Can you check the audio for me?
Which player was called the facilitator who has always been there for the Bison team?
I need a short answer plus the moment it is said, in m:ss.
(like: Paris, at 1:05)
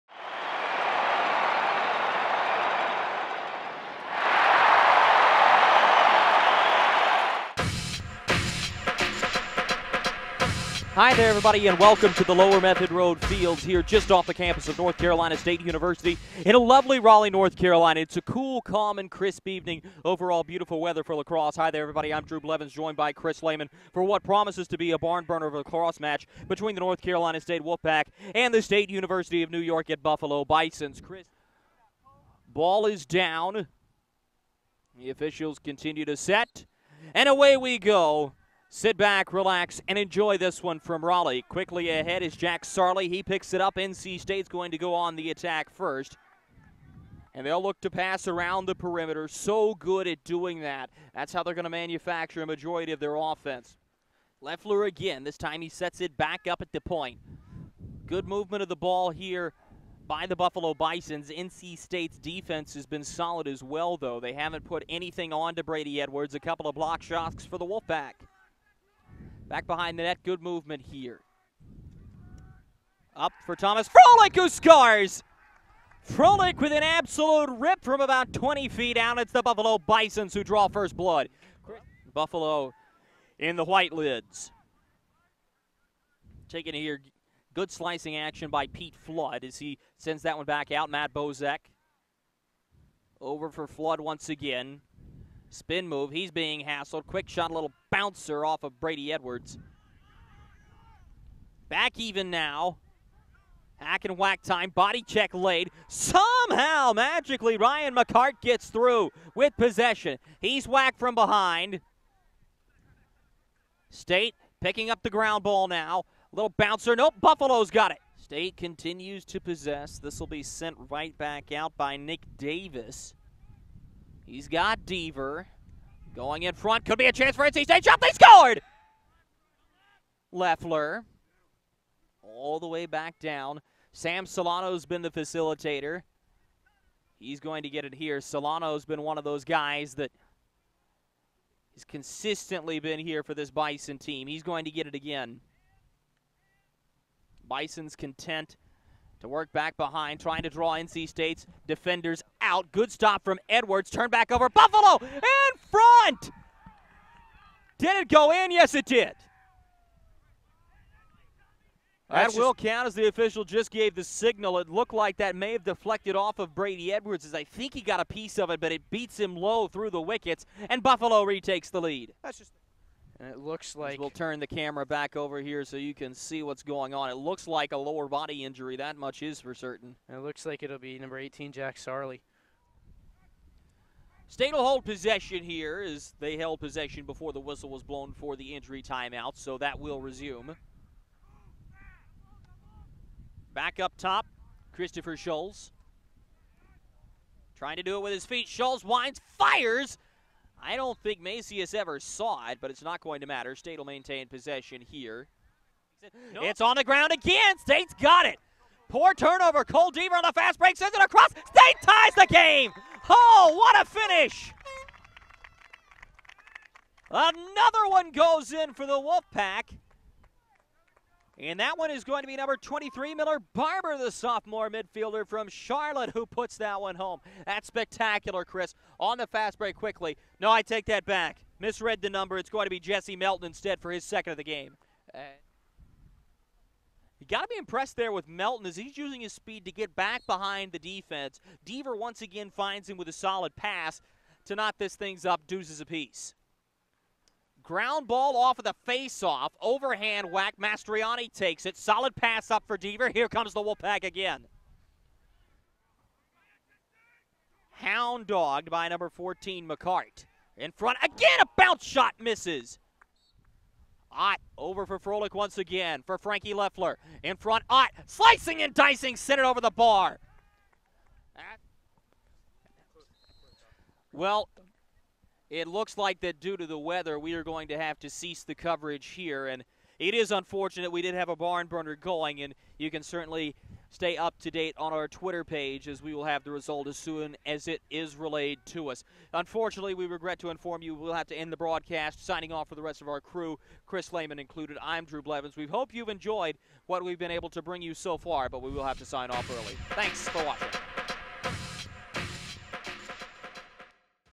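Sam Solano, at 2:13.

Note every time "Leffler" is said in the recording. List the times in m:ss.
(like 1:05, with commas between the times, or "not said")
0:54, 2:10, 4:26.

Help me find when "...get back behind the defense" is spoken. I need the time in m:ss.
3:59.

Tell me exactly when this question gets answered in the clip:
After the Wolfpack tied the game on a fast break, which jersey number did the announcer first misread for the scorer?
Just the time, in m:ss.
3:42.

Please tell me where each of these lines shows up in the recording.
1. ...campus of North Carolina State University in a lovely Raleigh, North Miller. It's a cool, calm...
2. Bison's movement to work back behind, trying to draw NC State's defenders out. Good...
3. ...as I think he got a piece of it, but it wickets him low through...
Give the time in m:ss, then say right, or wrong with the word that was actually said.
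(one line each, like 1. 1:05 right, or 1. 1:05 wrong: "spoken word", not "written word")
1. 0:14 wrong: "Carolina", not "Miller"
2. 2:27 wrong: "content", not "movement"
3. 2:47 wrong: "beats", not "wickets".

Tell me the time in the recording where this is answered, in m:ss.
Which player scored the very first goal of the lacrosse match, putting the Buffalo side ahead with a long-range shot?
1:13.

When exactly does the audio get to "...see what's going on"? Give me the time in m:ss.
2:56.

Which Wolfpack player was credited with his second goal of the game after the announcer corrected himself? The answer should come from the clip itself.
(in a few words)
Jesse Melton.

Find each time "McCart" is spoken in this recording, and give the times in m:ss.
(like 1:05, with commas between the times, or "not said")
1:47, 4:19.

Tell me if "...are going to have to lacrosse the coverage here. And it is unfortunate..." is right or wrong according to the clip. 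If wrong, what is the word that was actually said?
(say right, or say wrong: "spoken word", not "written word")
wrong: "cease", not "lacrosse".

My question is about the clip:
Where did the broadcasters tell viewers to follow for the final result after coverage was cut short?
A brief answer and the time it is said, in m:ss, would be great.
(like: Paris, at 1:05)
Twitter page, at 4:45.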